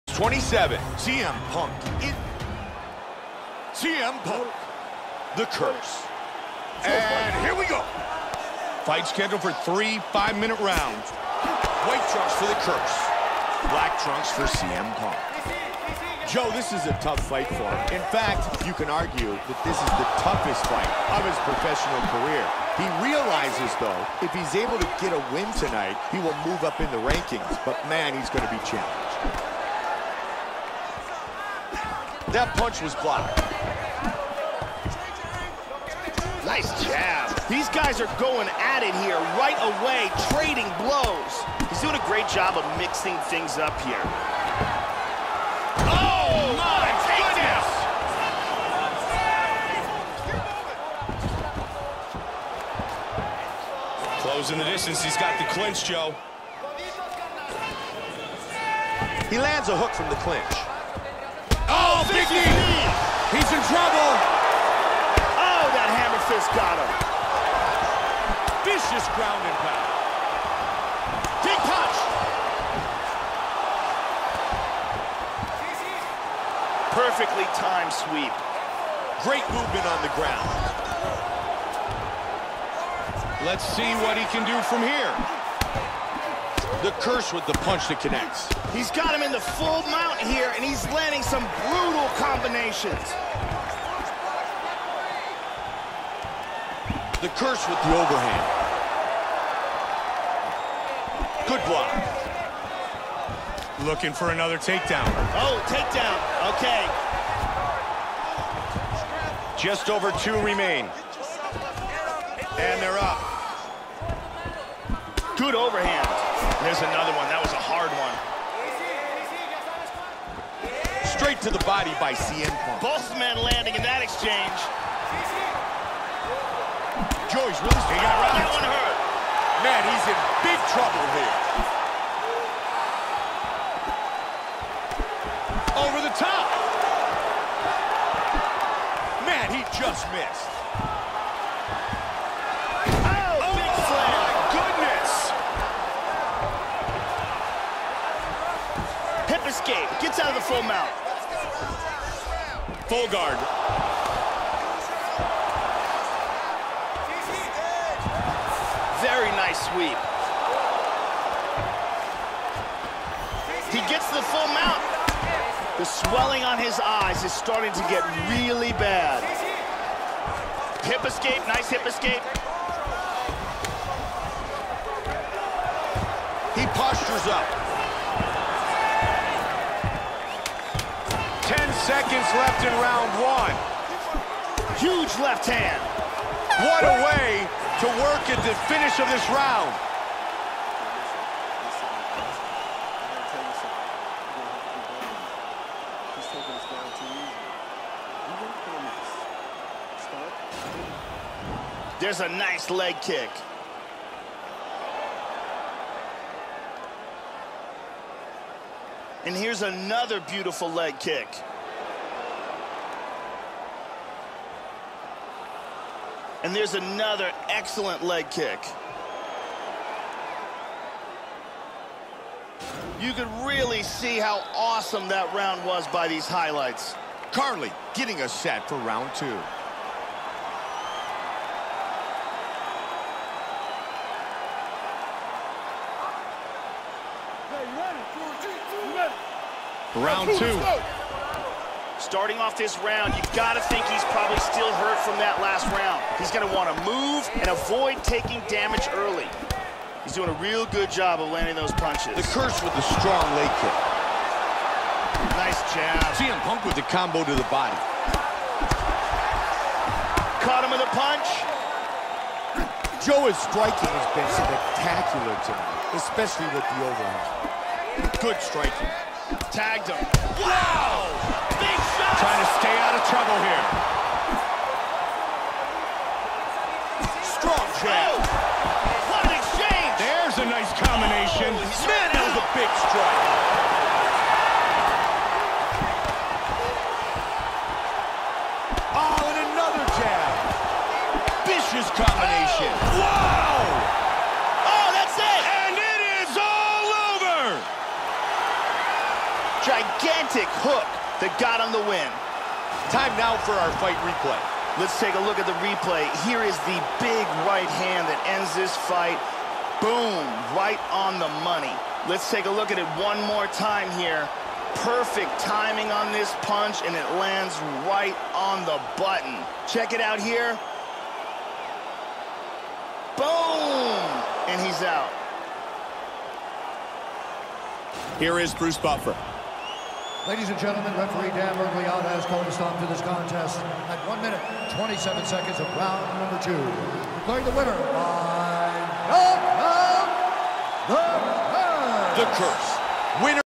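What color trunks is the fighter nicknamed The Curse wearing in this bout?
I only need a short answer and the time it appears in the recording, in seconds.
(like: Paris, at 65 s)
White, at 11 s.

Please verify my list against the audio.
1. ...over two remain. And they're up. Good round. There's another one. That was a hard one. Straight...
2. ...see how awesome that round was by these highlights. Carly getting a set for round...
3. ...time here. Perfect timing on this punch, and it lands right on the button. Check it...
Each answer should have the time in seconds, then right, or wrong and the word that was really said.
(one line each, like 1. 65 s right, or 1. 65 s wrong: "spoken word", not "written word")
1. 109 s wrong: "overhand", not "round"
2. 223 s right
3. 313 s right.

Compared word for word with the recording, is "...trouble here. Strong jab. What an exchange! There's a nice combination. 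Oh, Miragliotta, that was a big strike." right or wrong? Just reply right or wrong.
wrong.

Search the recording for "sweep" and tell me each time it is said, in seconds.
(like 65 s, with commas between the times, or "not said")
77 s, 159 s.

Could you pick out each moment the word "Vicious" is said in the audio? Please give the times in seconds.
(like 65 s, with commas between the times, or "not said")
68 s, 291 s.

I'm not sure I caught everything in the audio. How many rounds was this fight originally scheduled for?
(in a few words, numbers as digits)
3.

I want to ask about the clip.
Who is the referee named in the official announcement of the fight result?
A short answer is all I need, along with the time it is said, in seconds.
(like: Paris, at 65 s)
Dan Miragliotta, at 331 s.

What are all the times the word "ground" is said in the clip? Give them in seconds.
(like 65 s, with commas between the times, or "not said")
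69 s, 80 s.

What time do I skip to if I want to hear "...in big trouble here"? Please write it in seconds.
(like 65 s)
130 s.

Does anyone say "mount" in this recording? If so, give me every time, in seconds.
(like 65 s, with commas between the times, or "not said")
89 s, 150 s, 164 s.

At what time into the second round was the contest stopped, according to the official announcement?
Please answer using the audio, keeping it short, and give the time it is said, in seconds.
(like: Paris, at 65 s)
1 minute 27 seconds, at 334 s.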